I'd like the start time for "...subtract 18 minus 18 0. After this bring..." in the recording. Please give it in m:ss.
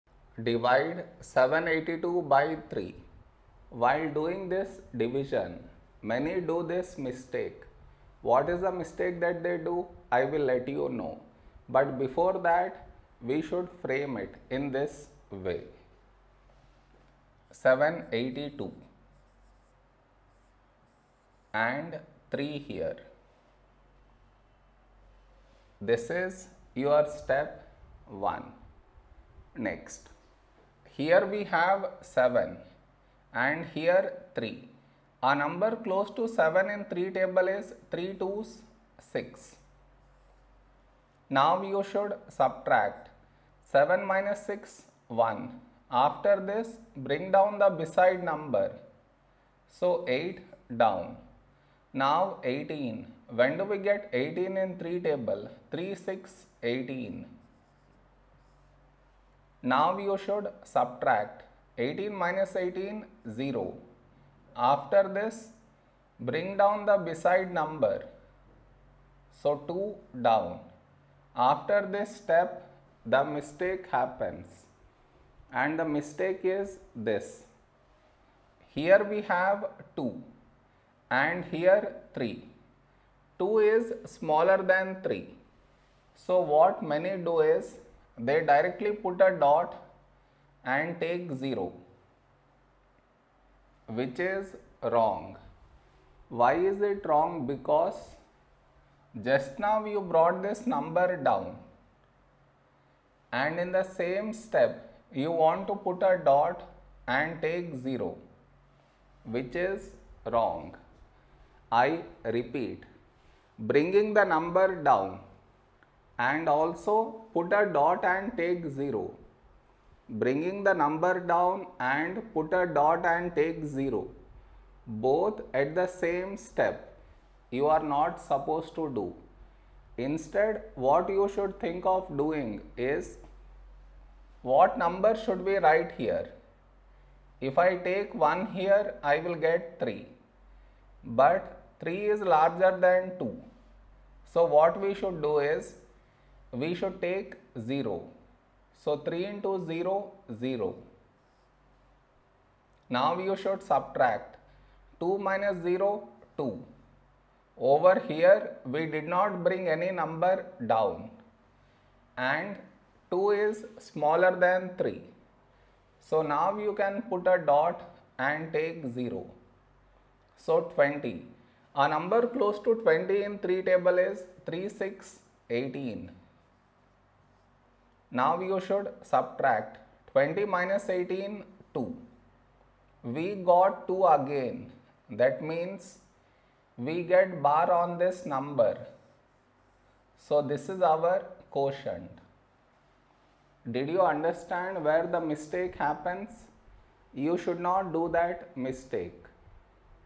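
1:00.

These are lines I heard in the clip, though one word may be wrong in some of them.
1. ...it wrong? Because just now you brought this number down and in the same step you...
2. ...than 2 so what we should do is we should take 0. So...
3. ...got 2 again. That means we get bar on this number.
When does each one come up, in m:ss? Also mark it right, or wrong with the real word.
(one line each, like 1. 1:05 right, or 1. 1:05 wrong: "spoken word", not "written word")
1. 1:36 right
2. 2:22 right
3. 3:03 right.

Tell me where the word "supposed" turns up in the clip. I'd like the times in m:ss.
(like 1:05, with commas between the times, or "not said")
2:08.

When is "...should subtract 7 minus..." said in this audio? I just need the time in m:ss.
0:41.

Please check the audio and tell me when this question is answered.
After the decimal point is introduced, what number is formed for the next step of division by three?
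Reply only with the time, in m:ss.
2:50.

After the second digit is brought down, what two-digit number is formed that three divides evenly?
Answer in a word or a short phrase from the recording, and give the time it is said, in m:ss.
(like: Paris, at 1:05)
18, at 0:51.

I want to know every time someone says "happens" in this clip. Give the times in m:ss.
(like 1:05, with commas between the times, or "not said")
1:13, 3:15.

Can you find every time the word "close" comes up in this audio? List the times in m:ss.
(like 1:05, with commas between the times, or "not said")
0:35, 2:52.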